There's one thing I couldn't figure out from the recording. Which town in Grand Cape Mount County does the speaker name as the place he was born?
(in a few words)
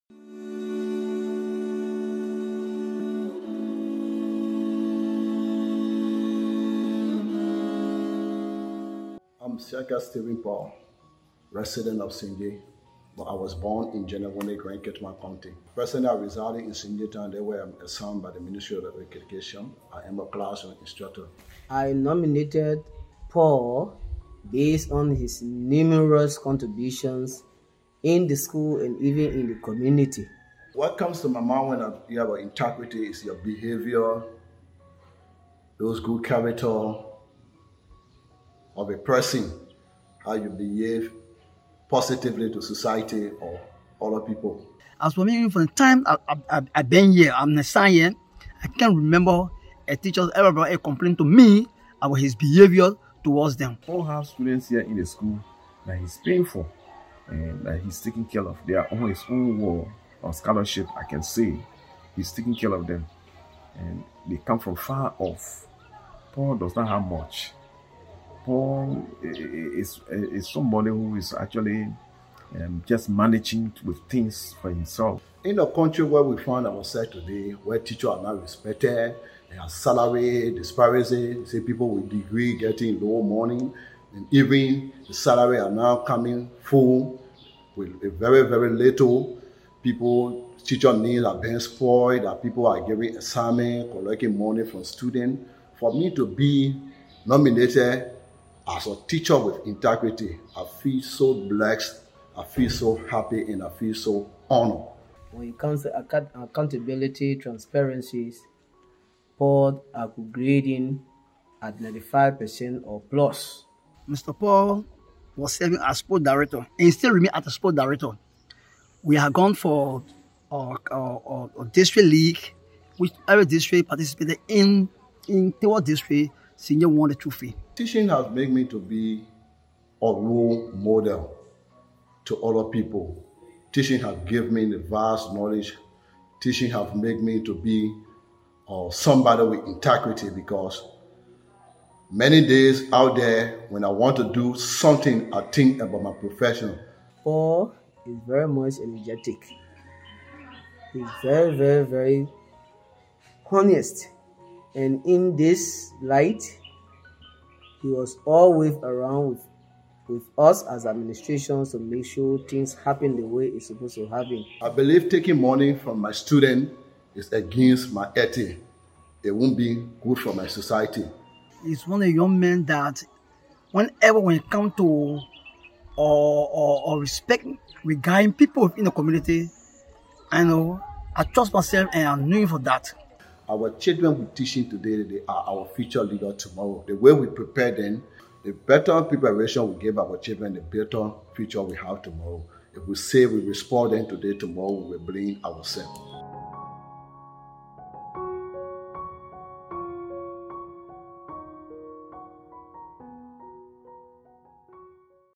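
Genevone.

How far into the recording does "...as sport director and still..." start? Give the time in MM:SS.
01:55.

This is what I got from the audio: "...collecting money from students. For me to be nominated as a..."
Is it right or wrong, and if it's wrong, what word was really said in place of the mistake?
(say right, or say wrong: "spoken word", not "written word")
right.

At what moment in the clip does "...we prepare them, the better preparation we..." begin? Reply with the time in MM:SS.
03:07.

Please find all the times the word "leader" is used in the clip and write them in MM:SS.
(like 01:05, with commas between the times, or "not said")
03:06.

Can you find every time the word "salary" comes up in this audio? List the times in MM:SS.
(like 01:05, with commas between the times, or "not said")
01:19, 01:25.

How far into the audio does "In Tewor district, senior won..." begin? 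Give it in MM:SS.
02:05.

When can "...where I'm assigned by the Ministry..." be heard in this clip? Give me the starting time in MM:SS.
00:17.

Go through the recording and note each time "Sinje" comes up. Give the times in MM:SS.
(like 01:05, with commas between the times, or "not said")
00:12, 00:16.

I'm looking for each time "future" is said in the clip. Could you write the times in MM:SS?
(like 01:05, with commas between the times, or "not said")
03:05, 03:11.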